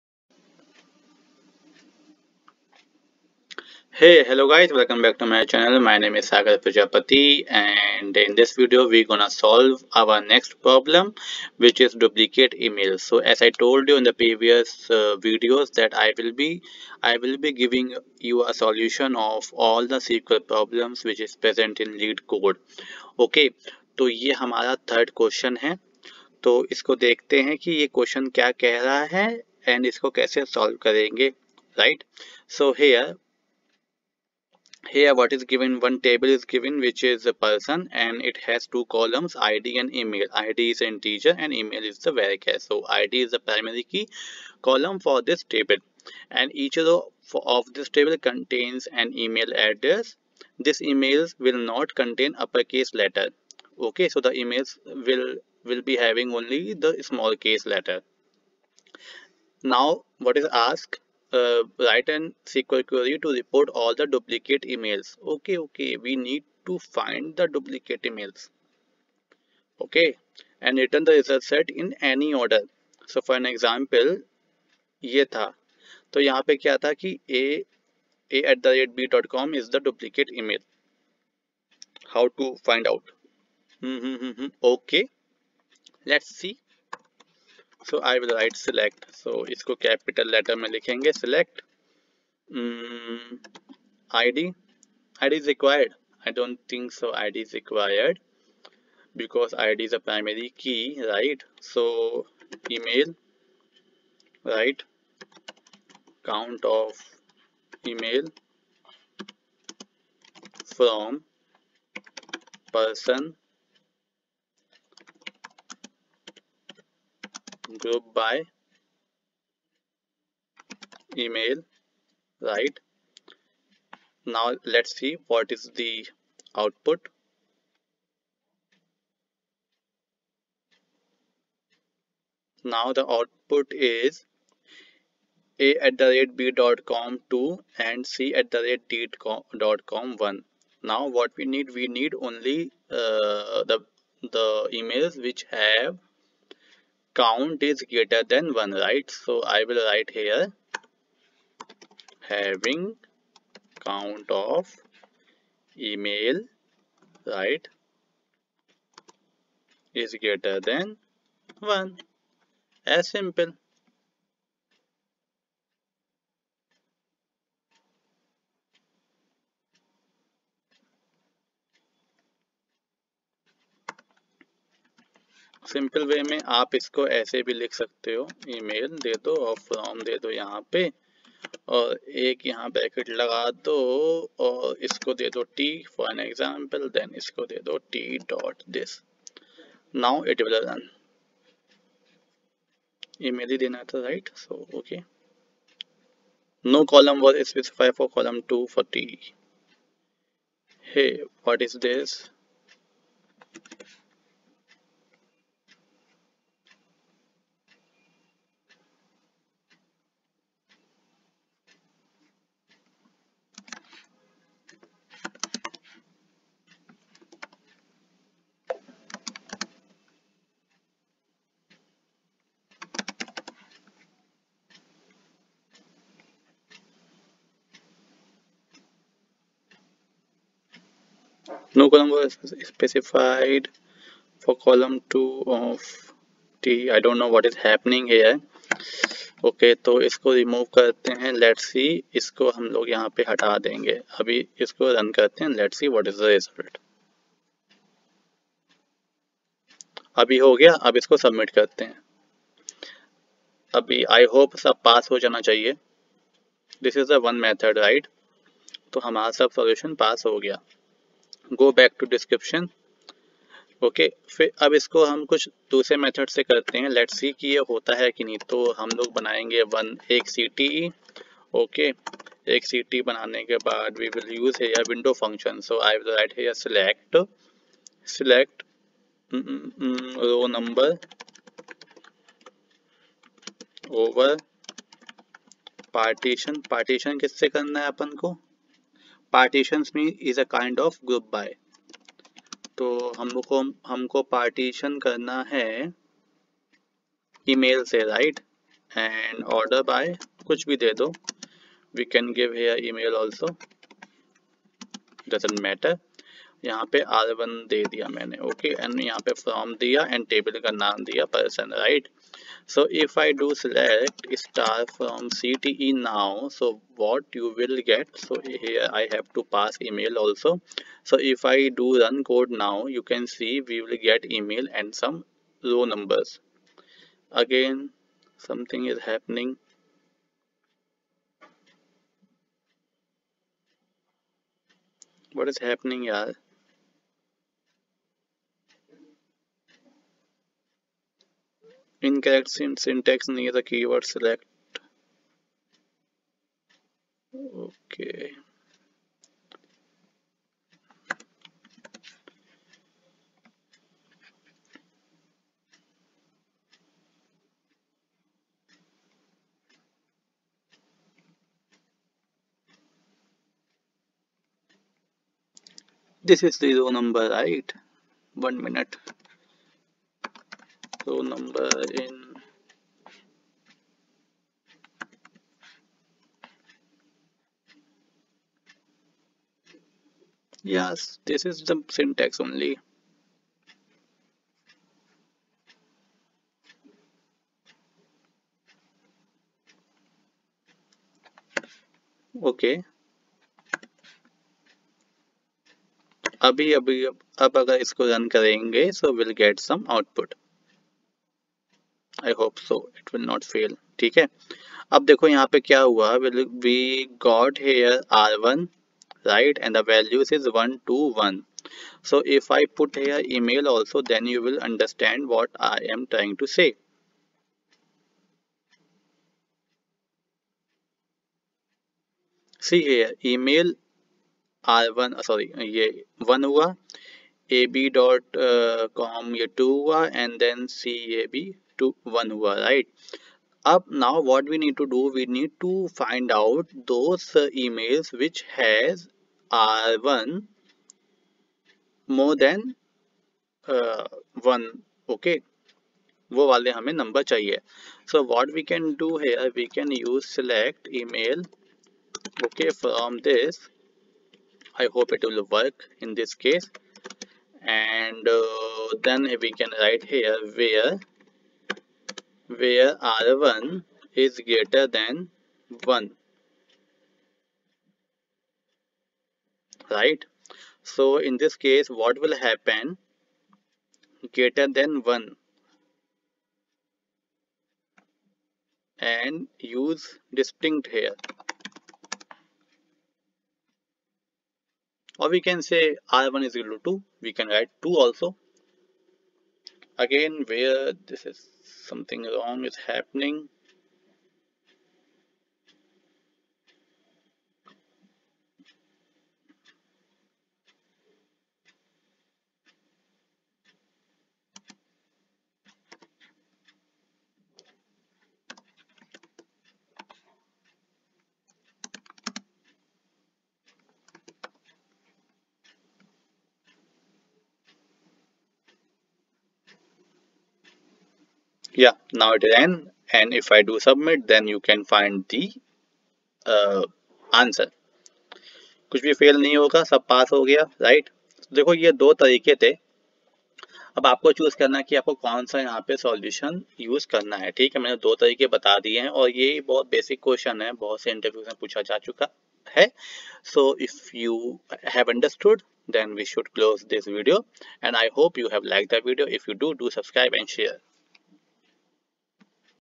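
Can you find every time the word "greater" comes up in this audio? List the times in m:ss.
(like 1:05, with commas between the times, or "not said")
2:27, 2:40, 7:44, 7:54.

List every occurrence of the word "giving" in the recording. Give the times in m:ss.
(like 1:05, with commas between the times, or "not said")
0:17.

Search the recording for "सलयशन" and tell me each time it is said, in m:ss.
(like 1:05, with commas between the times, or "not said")
4:19, 8:55.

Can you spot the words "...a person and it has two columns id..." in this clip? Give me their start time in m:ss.
0:37.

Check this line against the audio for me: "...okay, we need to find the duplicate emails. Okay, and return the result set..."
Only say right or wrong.
right.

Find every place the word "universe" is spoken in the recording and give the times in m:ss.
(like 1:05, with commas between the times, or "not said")
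not said.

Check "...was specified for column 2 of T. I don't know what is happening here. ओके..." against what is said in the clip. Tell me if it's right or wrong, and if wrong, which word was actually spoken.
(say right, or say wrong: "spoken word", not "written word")
right.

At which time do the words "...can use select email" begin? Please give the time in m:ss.
7:29.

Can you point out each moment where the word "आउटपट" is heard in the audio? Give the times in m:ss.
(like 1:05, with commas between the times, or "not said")
6:39.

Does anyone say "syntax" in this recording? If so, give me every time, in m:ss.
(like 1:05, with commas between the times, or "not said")
5:42, 6:21.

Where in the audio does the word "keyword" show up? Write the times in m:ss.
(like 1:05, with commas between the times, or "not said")
5:43.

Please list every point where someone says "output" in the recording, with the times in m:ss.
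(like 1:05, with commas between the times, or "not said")
2:06, 2:13.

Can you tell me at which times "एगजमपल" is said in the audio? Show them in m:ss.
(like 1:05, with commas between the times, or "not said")
3:06.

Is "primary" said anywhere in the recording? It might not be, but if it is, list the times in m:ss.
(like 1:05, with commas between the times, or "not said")
0:43, 1:40.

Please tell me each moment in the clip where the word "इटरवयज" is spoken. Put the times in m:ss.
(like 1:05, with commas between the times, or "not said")
9:01.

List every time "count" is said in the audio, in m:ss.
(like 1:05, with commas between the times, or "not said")
1:46, 2:27, 2:33.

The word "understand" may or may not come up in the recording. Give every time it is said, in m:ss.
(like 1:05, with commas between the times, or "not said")
6:54.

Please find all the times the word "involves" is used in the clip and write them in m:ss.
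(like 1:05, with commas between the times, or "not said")
not said.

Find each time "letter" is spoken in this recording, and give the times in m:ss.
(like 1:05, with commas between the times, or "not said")
0:53, 0:57, 1:30.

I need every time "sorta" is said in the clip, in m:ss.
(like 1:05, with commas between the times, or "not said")
not said.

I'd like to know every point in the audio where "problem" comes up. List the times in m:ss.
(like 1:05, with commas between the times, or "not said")
0:10, 0:20.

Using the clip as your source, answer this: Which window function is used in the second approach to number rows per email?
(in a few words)
row number.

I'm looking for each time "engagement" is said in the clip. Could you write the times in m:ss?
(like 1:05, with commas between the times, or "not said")
not said.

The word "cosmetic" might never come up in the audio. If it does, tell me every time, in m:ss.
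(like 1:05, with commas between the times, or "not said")
not said.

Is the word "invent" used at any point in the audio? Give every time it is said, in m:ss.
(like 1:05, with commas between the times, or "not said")
not said.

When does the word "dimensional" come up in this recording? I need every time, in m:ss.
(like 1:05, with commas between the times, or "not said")
not said.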